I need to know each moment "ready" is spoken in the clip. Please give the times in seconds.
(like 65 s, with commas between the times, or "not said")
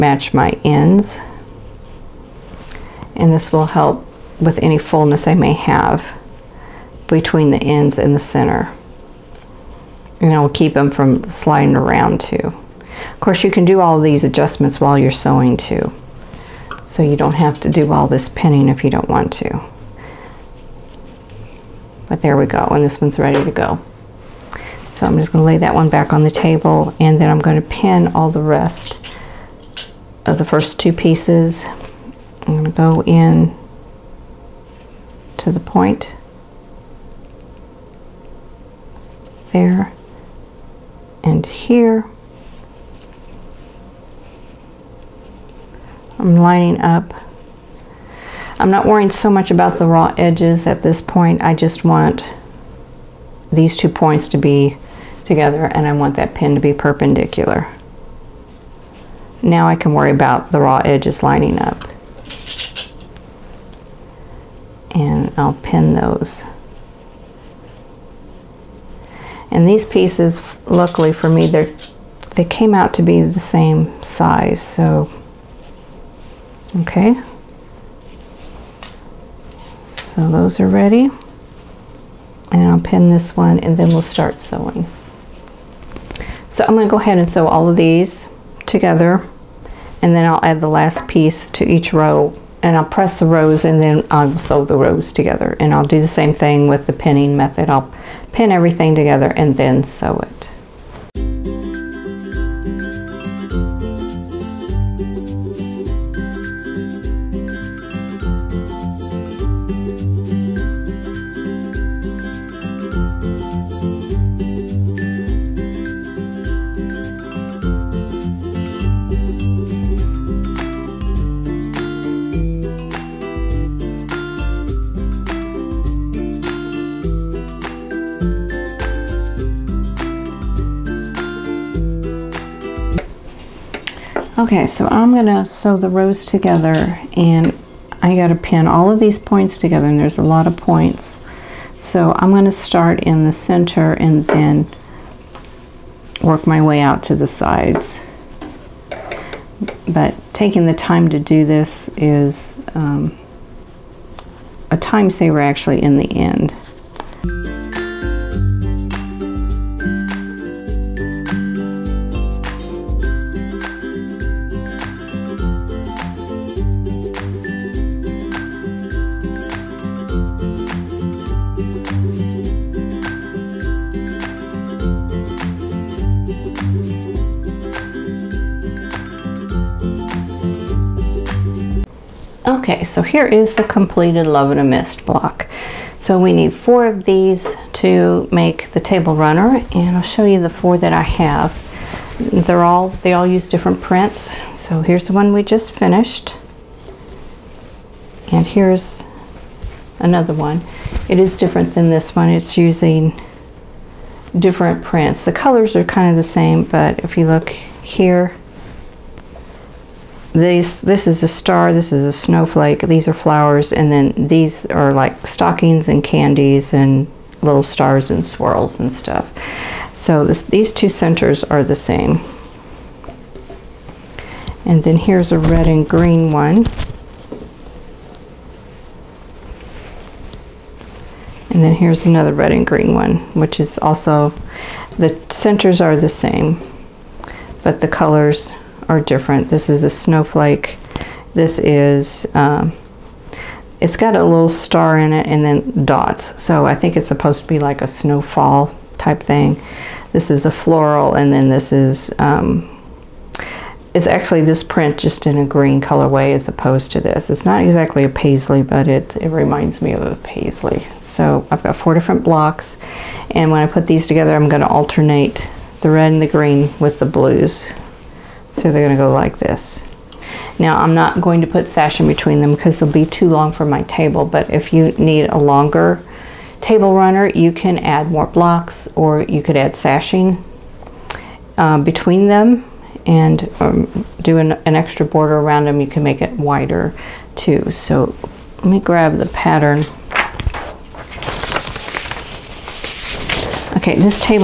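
23 s, 80 s.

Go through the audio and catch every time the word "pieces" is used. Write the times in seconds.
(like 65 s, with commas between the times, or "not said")
30 s, 69 s, 91 s.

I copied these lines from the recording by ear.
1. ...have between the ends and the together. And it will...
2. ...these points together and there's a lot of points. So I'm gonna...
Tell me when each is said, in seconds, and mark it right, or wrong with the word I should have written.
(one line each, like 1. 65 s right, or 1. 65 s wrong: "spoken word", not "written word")
1. 5 s wrong: "center", not "together"
2. 138 s right.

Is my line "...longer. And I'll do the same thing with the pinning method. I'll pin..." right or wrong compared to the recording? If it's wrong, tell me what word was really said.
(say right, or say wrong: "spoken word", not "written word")
wrong: "together", not "longer".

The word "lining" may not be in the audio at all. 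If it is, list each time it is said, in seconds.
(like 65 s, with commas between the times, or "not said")
46 s, 61 s.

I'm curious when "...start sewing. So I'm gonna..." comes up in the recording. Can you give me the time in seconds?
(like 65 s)
84 s.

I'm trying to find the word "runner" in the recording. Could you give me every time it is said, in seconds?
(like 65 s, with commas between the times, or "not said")
189 s, 276 s.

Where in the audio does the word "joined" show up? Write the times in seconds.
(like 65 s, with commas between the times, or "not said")
not said.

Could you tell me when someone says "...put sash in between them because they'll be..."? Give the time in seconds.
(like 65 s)
271 s.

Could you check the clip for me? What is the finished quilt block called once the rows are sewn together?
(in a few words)
Love in a Mist.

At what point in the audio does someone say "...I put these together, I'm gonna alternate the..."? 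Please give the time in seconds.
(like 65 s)
263 s.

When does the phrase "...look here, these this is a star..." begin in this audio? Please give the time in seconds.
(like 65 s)
207 s.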